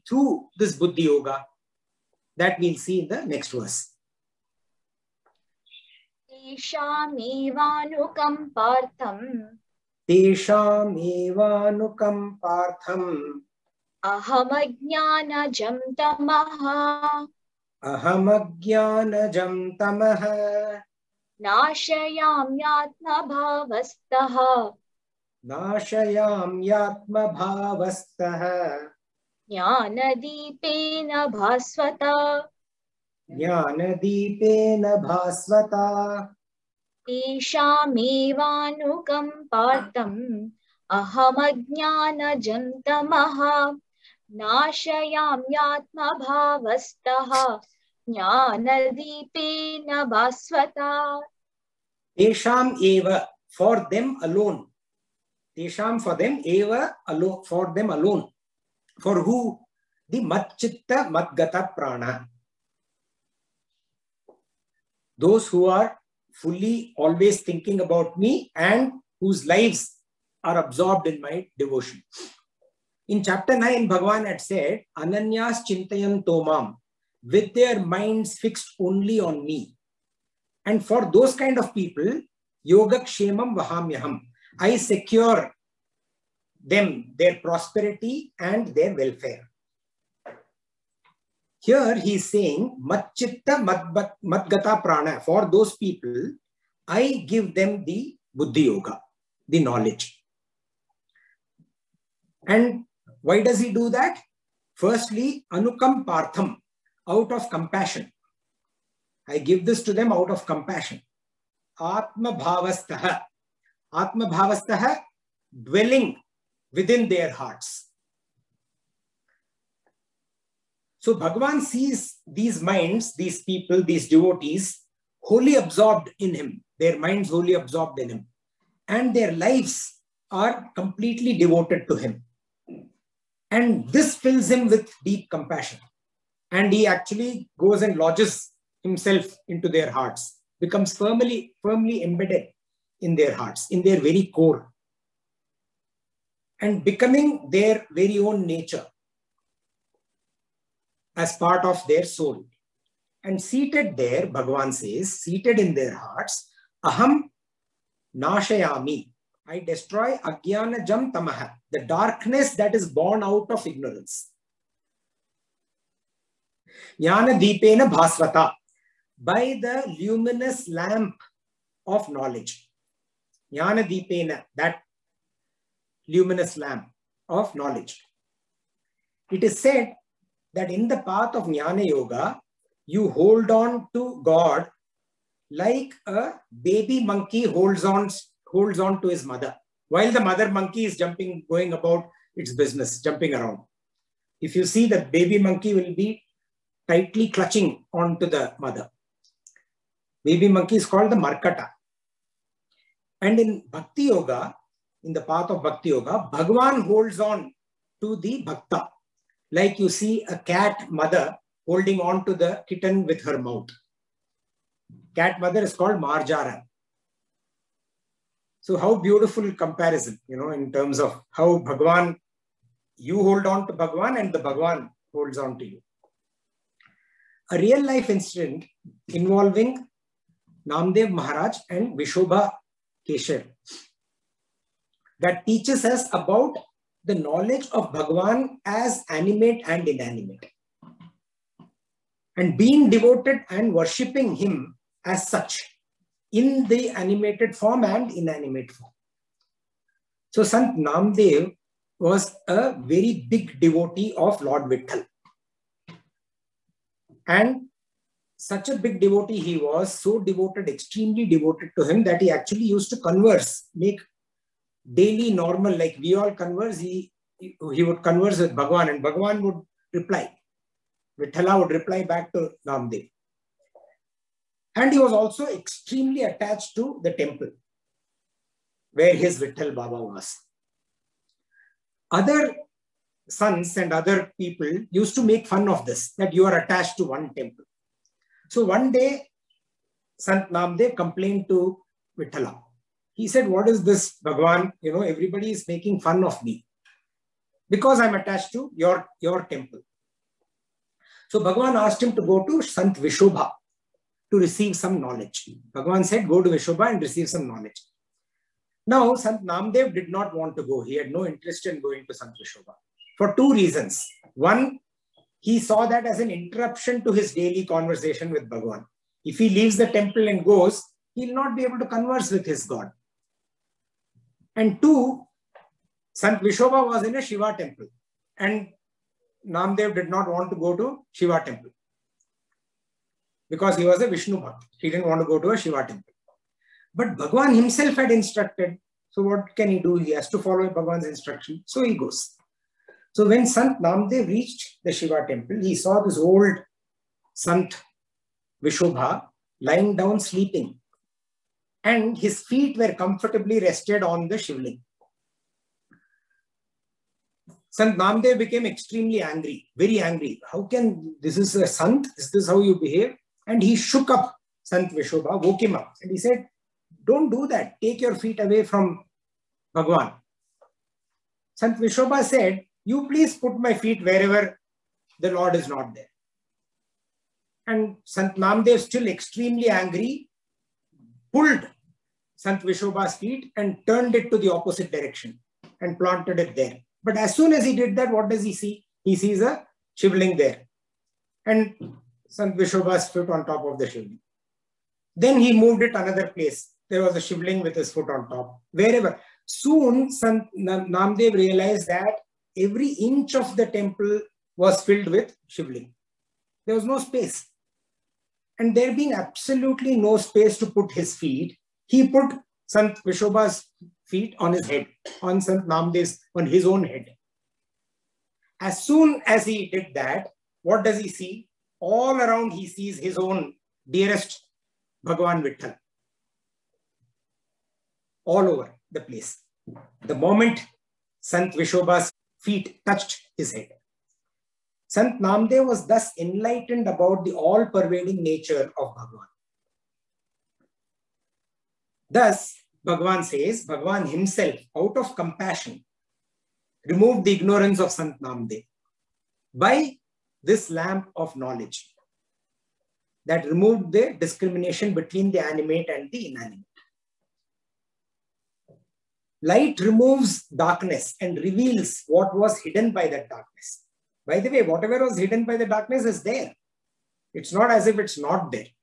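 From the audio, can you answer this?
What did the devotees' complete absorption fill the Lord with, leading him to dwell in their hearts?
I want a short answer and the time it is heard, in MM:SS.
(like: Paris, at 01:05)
Deep compassion, at 02:15.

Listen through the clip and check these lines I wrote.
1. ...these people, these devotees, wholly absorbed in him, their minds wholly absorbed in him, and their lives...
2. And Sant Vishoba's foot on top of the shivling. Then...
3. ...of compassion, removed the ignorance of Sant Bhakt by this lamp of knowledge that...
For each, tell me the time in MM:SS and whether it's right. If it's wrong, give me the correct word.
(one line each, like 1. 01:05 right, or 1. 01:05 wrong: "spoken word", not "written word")
1. 02:03 right
2. 06:31 right
3. 07:24 wrong: "Namdev", not "Bhakt".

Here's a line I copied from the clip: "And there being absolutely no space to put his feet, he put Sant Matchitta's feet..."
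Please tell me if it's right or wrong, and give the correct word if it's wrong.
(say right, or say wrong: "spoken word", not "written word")
wrong: "Vishoba", not "Matchitta".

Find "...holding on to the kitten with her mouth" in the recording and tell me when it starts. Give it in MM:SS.
03:31.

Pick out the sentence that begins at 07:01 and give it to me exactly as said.
All around he sees his own dearest Bhagavan Vittal.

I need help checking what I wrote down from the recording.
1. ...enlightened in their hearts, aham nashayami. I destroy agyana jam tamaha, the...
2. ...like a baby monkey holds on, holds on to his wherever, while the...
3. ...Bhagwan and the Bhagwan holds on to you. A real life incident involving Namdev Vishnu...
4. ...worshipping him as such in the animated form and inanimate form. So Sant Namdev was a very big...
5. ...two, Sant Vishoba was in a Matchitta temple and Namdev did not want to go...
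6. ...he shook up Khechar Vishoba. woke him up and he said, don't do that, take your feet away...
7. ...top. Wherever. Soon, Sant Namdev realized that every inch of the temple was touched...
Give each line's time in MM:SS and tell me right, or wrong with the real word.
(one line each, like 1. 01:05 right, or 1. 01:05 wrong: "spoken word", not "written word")
1. 02:35 wrong: "seated", not "enlightened"
2. 03:05 wrong: "mother", not "wherever"
3. 03:43 wrong: "Maharaj", not "Vishnu"
4. 04:03 right
5. 05:24 wrong: "Shiva", not "Matchitta"
6. 06:03 wrong: "Sant", not "Khechar"
7. 06:38 wrong: "filled", not "touched".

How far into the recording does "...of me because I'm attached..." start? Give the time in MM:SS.
04:56.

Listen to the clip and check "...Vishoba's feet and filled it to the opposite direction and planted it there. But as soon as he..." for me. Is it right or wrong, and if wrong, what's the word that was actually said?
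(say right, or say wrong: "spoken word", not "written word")
wrong: "turned", not "filled".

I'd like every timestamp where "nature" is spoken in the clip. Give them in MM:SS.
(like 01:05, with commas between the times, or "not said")
02:28, 07:18.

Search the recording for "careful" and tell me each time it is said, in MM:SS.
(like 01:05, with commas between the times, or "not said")
not said.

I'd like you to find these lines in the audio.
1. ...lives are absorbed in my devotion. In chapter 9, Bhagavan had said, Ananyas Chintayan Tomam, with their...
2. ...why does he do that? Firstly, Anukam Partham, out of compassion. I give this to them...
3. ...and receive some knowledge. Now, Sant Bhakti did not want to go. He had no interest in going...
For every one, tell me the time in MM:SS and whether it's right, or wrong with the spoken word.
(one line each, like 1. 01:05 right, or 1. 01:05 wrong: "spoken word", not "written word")
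1. 01:09 right
2. 01:43 right
3. 05:06 wrong: "Namdev", not "Bhakti".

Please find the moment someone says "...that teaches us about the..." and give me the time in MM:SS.
03:55.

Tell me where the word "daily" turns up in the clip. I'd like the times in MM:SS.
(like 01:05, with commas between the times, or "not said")
04:24, 05:17.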